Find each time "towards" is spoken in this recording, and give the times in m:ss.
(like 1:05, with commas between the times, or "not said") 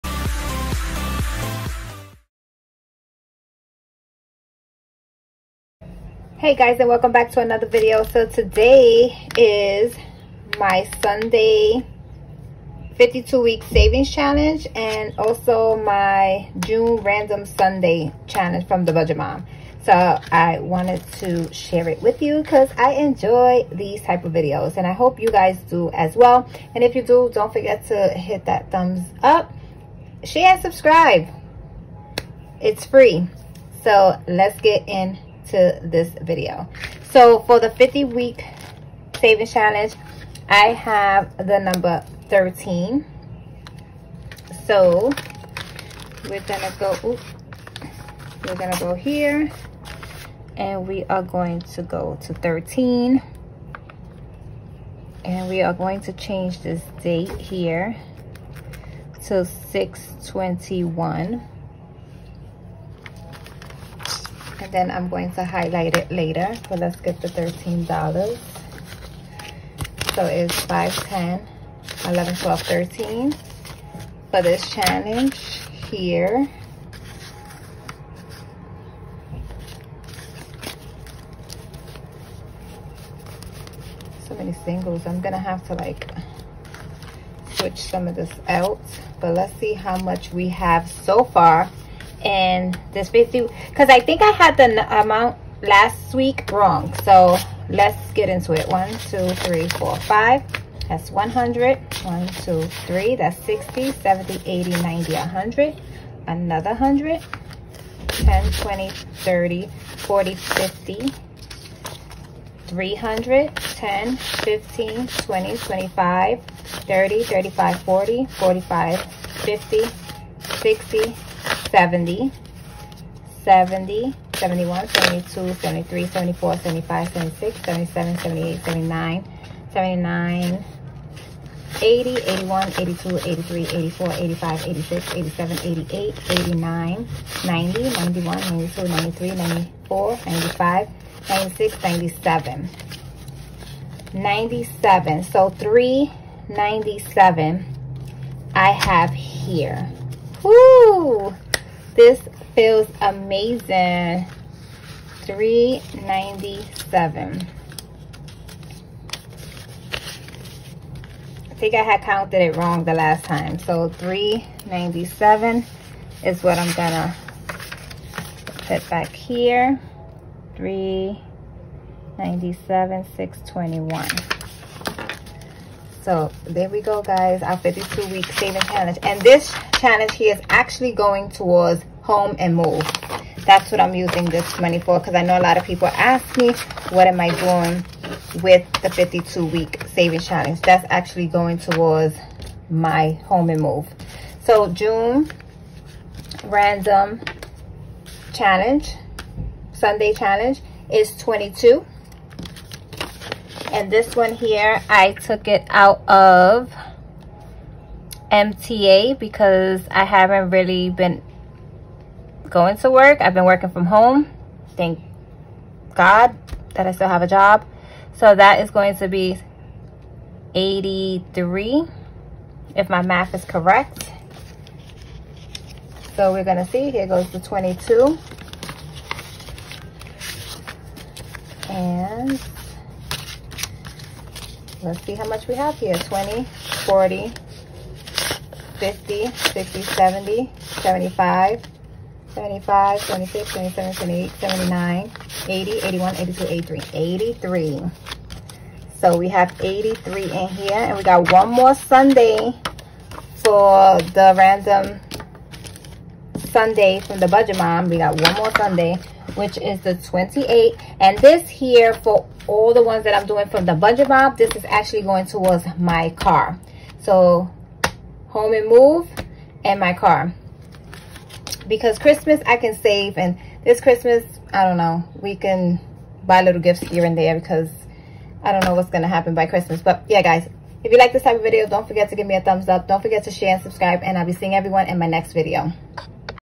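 3:01, 3:11, 4:25.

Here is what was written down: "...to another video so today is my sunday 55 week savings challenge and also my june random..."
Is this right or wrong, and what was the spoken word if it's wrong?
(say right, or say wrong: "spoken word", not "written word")
wrong: "52", not "55".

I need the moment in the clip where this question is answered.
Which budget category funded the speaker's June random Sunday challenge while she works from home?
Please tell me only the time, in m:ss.
3:28.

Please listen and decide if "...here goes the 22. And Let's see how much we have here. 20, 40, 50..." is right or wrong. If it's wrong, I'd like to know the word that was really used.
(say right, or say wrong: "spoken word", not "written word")
right.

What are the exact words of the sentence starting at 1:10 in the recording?
So it's 5, 10, 11, 12, 13 for this challenge here.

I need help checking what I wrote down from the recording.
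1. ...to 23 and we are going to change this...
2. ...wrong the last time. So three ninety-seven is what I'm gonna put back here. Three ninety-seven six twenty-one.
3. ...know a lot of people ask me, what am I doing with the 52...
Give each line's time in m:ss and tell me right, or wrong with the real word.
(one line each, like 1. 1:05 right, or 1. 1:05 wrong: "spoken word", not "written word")
1. 0:52 wrong: "13", not "23"
2. 2:42 right
3. 3:05 right.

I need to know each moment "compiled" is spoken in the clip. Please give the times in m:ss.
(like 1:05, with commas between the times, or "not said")
not said.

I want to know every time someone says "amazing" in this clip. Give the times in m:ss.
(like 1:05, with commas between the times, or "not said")
2:33.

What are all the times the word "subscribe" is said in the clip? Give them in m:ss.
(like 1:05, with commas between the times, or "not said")
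0:30, 4:43.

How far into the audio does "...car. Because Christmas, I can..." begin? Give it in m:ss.
4:29.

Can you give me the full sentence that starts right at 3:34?
Thank God that I still have a job.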